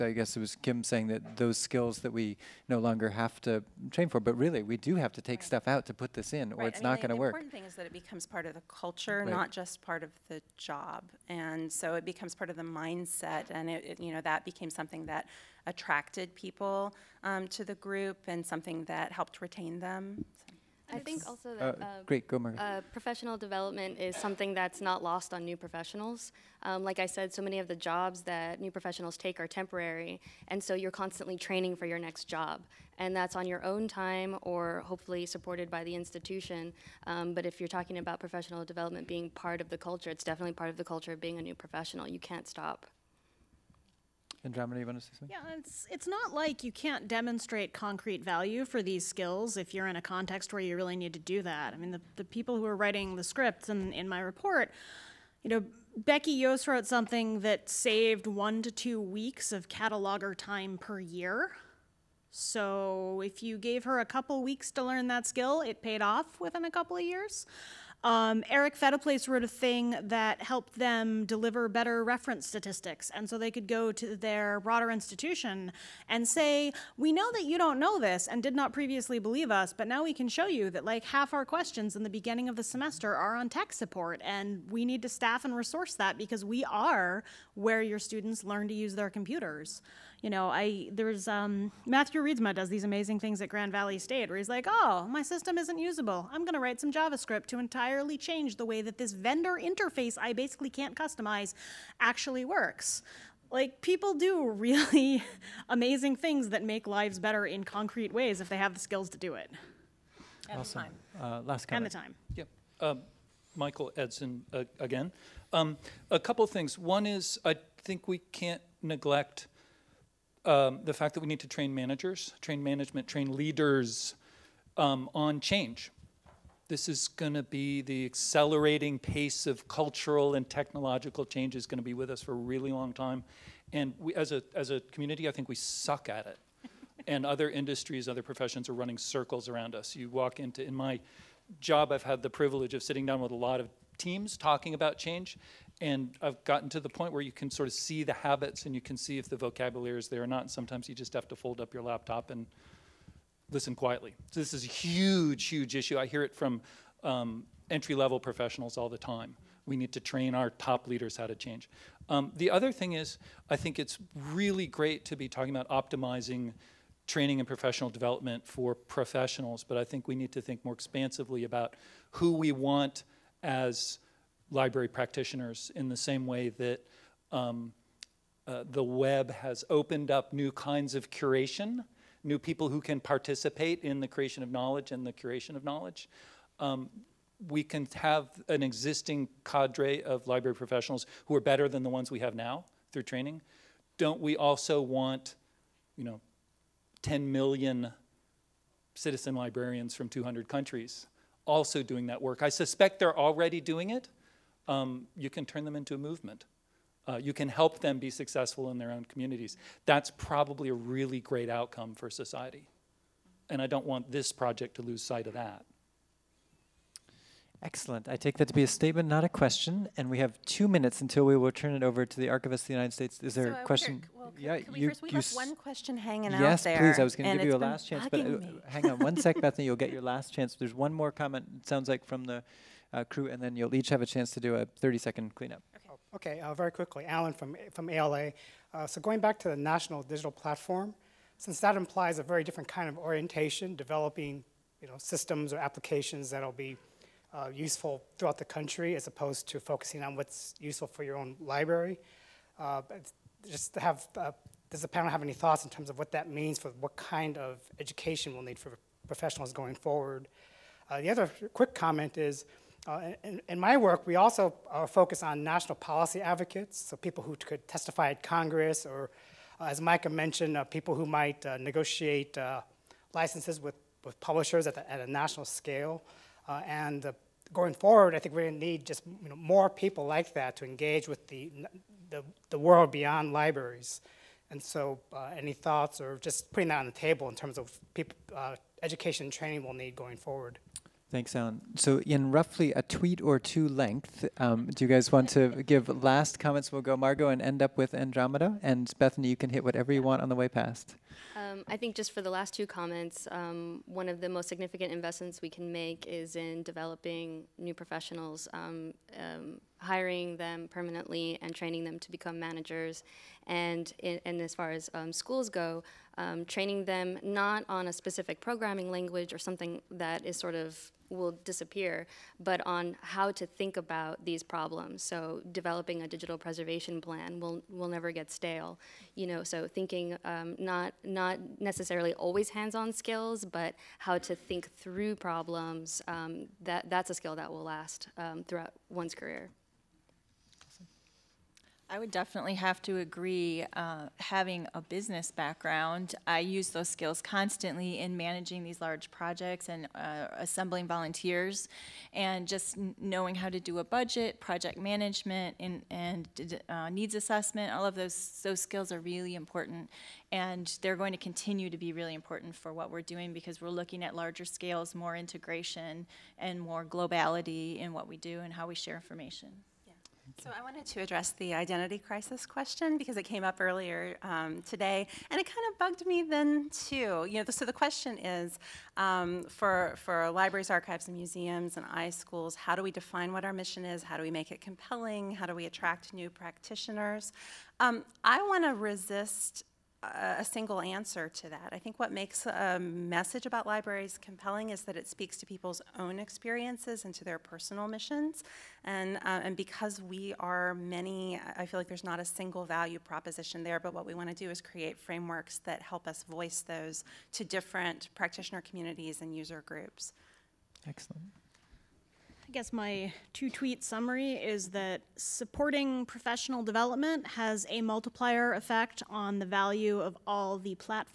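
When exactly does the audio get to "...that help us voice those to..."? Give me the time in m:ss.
6:45.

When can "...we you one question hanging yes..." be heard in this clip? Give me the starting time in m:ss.
3:45.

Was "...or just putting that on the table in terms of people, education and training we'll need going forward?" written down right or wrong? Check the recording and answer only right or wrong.
right.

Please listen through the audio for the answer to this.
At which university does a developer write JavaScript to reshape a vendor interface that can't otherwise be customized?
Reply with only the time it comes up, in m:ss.
1:33.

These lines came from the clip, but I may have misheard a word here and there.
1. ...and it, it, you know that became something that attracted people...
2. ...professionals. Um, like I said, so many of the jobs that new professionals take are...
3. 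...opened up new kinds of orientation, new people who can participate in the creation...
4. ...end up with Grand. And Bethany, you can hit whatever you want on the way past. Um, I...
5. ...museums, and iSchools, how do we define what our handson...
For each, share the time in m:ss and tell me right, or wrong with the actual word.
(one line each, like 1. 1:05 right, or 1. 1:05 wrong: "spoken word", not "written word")
1. 0:13 right
2. 0:25 right
3. 2:59 wrong: "curation", not "orientation"
4. 4:57 wrong: "Andromeda", not "Grand"
5. 6:21 wrong: "mission", not "handson".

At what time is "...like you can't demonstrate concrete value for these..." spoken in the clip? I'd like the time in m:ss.
0:46.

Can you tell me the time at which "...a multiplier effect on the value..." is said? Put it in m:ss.
6:57.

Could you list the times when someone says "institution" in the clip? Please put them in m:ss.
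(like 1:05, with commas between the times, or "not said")
0:35, 1:14.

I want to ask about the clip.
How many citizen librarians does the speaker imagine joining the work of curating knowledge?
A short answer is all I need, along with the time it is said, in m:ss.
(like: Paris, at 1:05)
10 million, at 3:17.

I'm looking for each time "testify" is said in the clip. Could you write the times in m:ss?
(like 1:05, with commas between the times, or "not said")
4:27.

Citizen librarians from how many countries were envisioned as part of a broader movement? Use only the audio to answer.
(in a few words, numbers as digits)
200.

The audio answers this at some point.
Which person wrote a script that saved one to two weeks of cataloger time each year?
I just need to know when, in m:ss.
0:55.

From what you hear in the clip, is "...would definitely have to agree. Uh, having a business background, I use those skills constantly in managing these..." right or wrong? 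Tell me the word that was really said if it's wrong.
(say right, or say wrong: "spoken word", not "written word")
right.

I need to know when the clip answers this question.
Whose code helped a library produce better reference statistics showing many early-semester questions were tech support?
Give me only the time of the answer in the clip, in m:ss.
1:08.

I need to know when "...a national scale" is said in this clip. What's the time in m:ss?
4:34.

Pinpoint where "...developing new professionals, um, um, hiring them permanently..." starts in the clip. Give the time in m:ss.
5:06.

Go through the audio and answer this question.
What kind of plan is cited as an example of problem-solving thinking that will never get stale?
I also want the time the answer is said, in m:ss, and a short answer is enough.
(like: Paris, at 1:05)
digital preservation plan, at 5:26.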